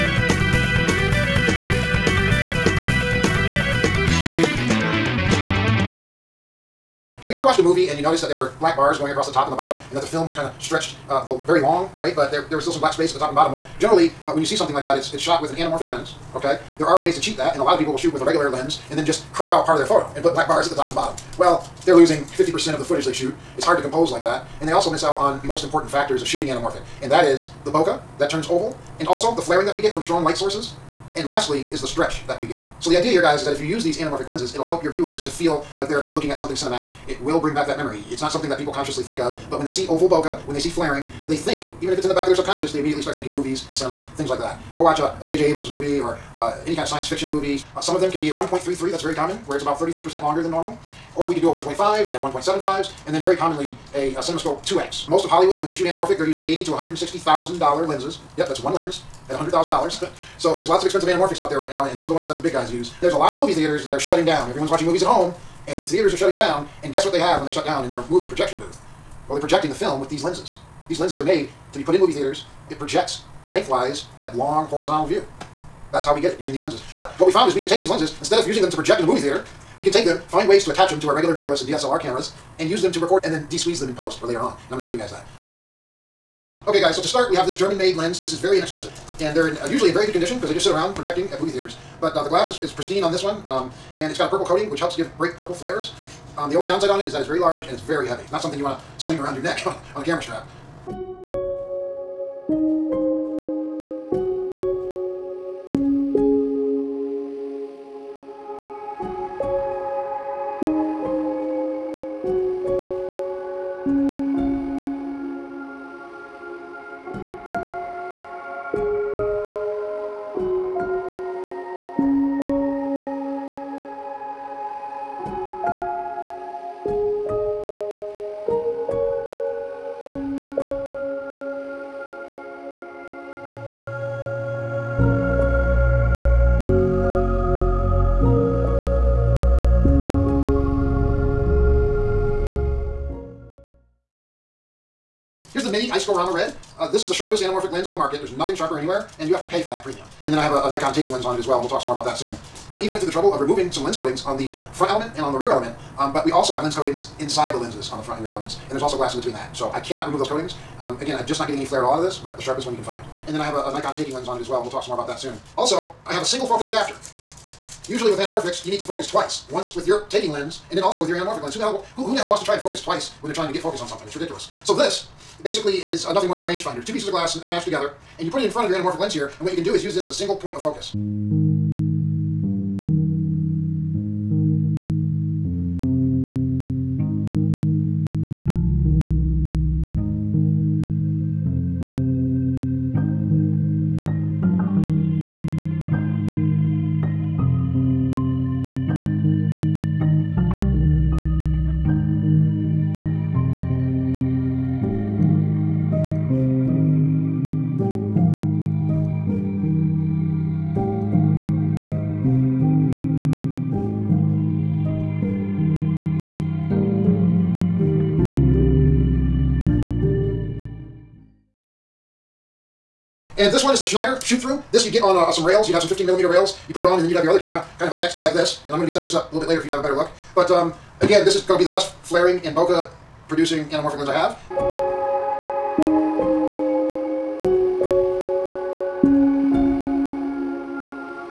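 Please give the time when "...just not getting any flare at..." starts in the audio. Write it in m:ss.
2:41.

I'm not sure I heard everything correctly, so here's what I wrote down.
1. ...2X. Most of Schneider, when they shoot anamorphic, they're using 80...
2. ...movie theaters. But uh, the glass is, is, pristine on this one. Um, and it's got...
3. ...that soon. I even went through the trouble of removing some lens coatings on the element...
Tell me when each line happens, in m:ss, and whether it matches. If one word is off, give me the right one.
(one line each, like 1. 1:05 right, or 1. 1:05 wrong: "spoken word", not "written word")
1. 0:54 wrong: "Hollywood", not "Schneider"
2. 1:31 right
3. 2:32 wrong: "front", not "element".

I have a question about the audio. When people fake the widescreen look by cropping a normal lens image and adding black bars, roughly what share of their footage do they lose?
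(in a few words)
50%.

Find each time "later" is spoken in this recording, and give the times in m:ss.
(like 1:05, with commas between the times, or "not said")
1:24, 3:49.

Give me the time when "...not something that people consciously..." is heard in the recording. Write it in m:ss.
0:38.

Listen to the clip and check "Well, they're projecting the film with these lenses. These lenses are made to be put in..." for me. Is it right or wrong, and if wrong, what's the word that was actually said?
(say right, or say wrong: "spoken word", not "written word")
right.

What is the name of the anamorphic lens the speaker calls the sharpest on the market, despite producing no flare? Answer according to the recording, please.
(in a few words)
Mini Iscorama Red.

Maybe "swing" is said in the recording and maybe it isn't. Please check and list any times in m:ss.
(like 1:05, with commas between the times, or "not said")
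1:39.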